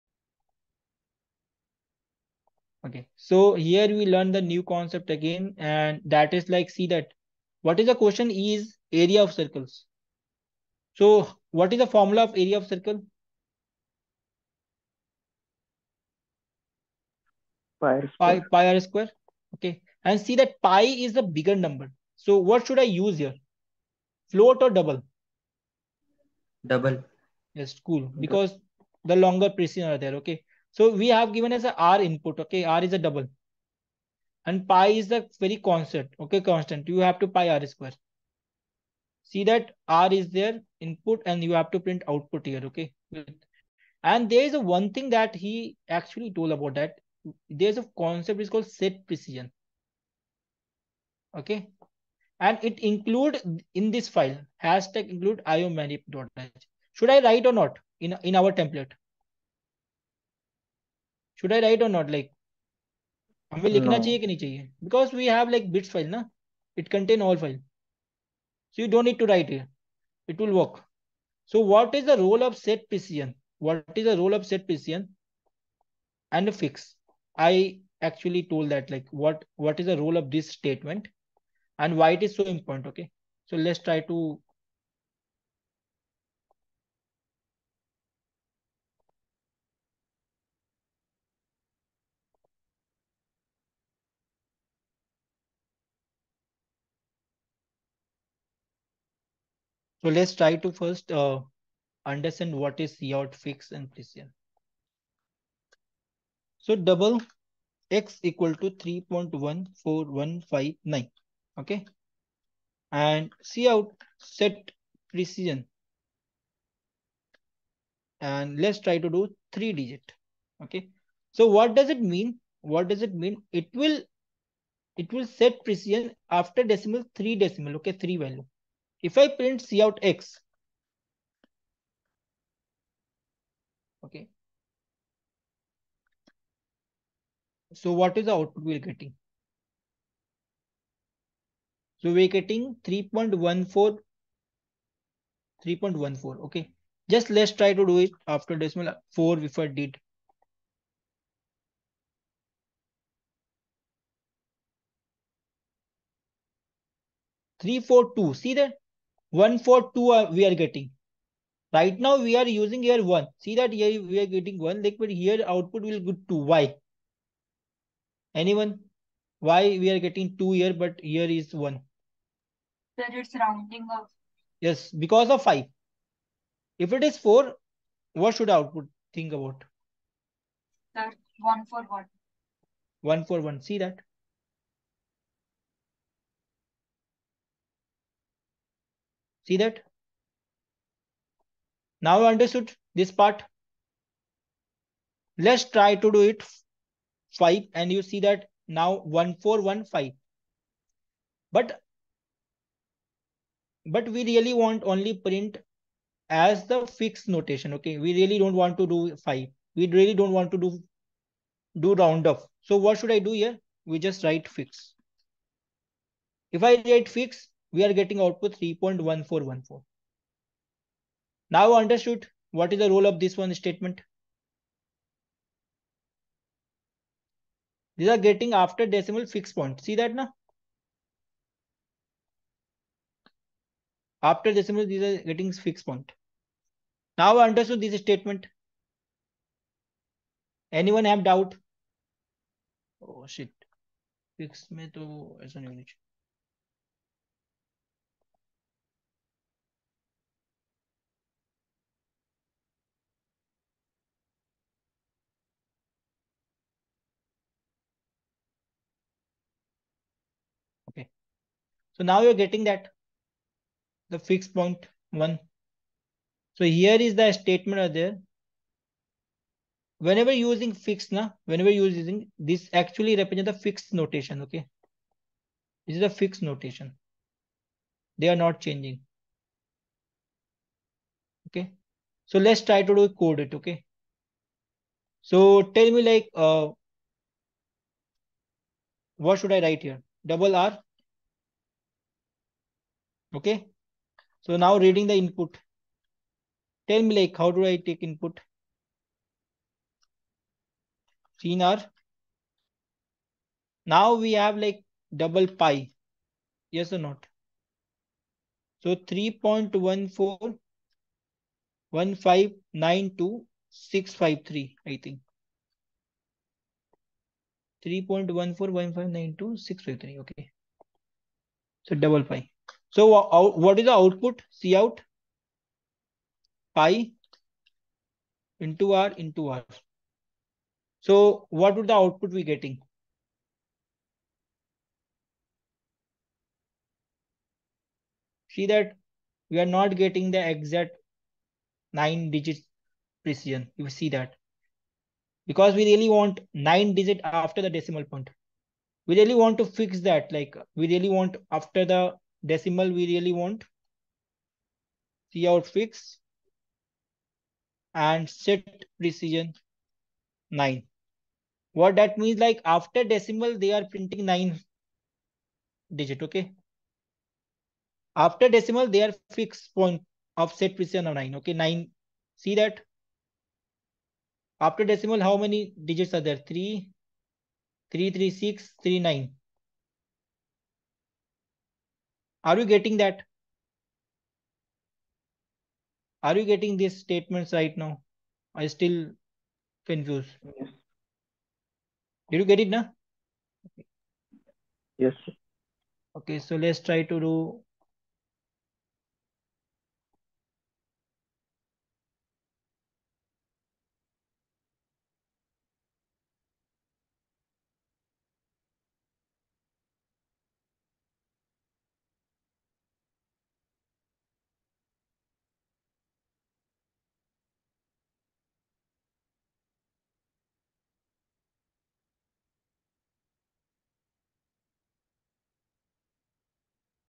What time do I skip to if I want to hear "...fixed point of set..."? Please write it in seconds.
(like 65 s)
369 s.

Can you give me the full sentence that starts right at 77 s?
I actually told that like what what is the role of this statement and why it is so important?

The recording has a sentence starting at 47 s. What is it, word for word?
There's a concept is called set precision.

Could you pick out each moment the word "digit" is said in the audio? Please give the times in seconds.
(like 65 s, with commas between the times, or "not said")
119 s, 342 s, 346 s, 365 s, 375 s.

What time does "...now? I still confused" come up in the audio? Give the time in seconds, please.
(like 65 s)
387 s.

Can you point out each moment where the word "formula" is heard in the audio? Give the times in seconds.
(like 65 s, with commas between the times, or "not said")
11 s.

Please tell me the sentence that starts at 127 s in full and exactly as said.
Okay, three value if I print C out X, okay.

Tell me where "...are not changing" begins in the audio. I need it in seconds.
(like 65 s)
278 s.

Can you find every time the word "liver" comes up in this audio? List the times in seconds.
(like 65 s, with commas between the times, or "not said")
not said.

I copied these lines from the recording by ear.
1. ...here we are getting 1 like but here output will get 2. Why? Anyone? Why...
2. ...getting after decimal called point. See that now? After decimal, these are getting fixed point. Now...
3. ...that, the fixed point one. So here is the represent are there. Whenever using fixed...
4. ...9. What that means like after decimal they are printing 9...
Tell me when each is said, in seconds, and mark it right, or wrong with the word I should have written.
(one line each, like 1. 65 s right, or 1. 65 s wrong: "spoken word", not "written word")
1. 163 s right
2. 228 s wrong: "fixed", not "called"
3. 262 s wrong: "statement", not "represent"
4. 360 s right.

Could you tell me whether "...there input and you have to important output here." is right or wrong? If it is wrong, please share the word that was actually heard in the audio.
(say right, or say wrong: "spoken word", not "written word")
wrong: "print", not "important".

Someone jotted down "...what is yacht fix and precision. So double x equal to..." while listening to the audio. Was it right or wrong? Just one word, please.
right.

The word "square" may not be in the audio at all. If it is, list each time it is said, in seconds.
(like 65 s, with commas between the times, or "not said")
18 s, 37 s.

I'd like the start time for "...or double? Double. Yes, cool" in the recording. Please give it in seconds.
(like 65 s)
24 s.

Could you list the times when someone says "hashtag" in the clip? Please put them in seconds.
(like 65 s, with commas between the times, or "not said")
54 s.